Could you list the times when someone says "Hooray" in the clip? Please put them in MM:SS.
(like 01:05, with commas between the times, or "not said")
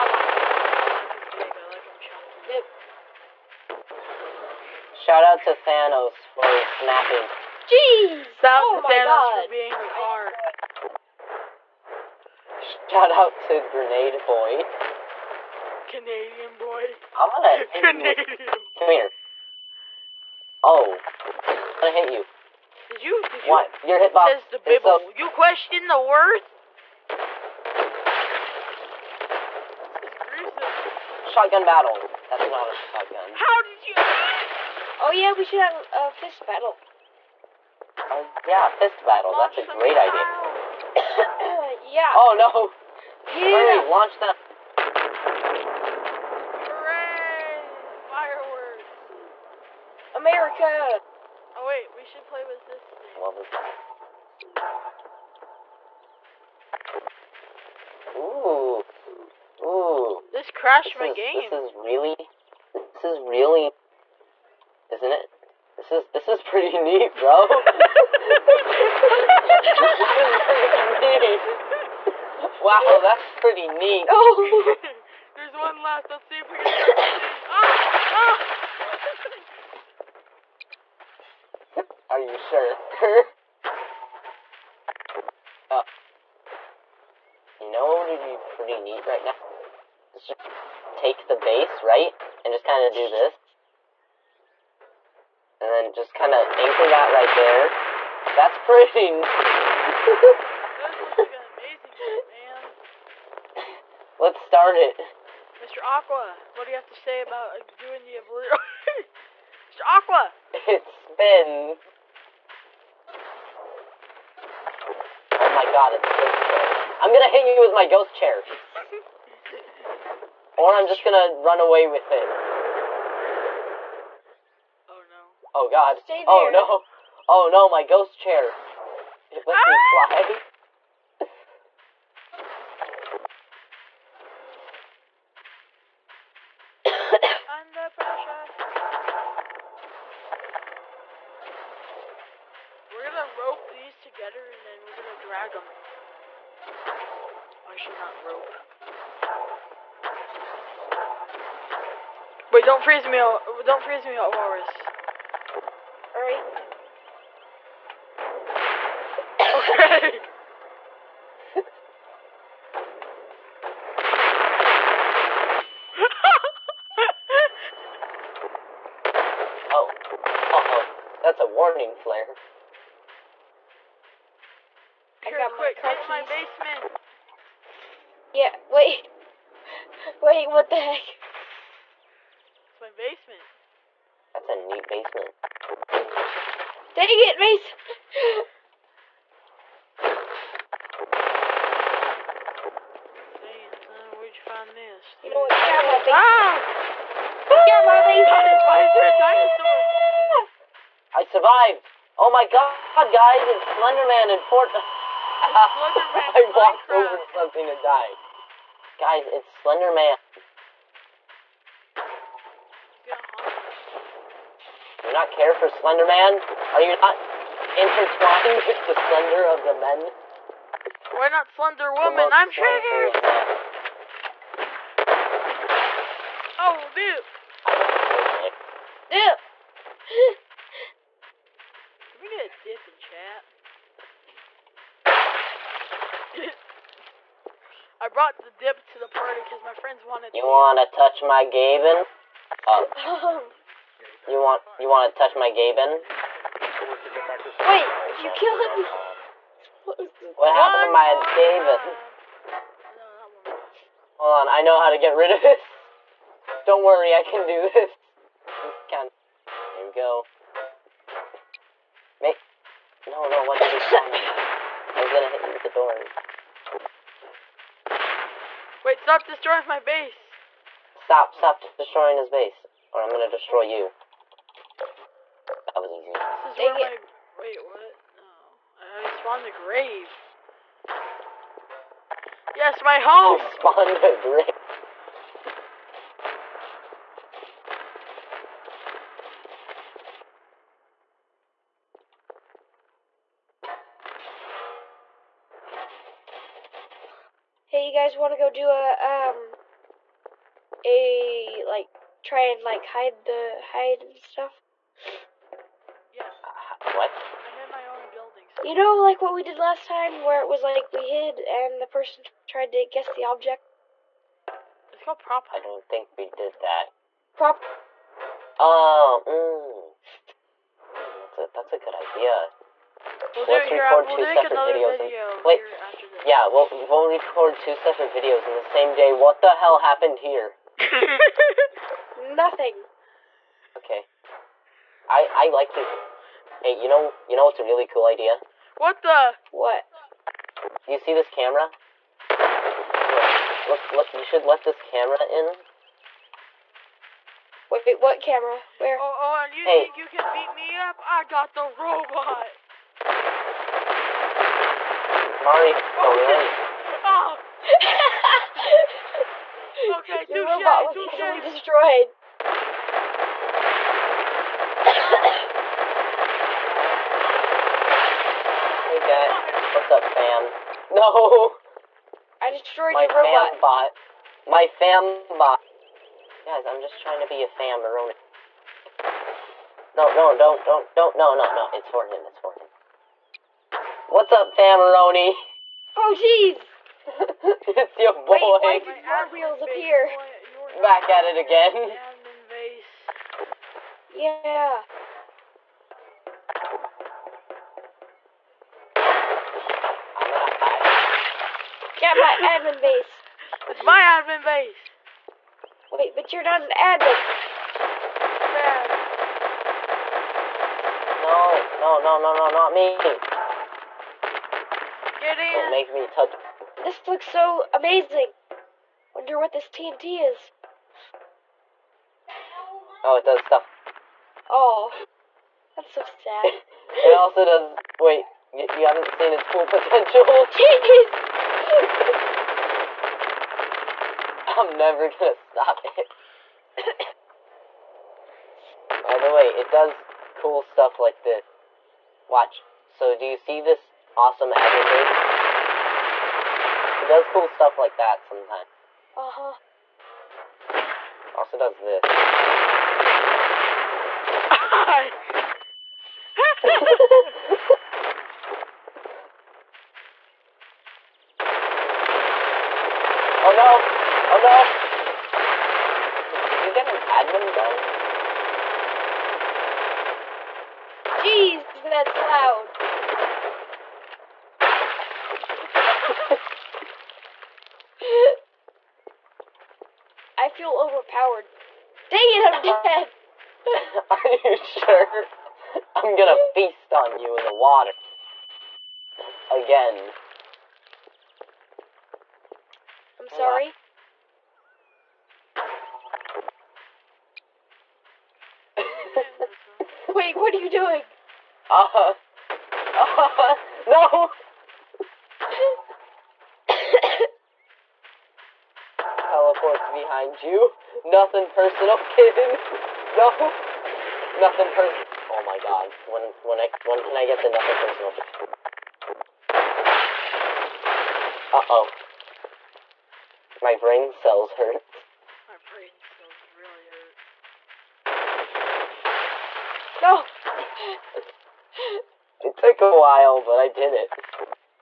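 00:46.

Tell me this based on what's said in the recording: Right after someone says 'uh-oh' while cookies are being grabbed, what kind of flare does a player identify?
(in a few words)
A warning flare.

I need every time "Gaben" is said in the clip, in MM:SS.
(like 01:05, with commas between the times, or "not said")
04:01, 04:05.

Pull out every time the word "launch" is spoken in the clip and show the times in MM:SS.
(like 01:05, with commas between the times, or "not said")
00:39, 00:43.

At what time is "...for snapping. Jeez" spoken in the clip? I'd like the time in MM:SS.
00:06.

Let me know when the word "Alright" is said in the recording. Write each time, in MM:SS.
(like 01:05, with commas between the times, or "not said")
02:36.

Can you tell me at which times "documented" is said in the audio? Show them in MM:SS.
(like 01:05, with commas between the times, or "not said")
not said.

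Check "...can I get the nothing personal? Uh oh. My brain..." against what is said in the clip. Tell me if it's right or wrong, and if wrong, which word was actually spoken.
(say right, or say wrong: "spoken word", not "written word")
right.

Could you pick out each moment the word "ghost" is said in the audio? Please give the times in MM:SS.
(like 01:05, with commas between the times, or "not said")
01:57, 02:07.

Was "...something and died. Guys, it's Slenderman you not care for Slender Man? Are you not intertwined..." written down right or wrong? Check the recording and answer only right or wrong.
right.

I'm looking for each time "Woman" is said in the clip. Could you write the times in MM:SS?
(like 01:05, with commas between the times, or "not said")
03:41.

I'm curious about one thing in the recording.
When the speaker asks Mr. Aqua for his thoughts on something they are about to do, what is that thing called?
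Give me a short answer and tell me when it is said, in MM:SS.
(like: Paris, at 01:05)
the obliterator, at 01:48.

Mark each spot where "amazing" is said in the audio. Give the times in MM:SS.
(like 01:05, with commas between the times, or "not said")
01:41, 06:57.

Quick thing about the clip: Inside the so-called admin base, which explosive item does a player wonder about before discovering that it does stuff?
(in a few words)
TNT.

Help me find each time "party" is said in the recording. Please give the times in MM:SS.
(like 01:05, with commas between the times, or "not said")
03:59.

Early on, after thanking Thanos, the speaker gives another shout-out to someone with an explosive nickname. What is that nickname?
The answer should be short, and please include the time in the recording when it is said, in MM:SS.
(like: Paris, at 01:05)
Grenade Boy, at 00:13.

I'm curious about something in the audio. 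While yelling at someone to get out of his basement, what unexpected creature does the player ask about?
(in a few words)
A dinosaur.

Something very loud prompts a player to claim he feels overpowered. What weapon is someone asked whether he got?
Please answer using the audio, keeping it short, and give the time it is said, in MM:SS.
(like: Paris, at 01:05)
An admin gun, at 07:47.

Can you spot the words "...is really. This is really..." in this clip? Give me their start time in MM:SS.
01:01.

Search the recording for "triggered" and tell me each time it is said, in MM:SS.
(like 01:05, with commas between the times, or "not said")
03:42.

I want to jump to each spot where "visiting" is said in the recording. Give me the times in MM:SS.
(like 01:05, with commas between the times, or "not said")
not said.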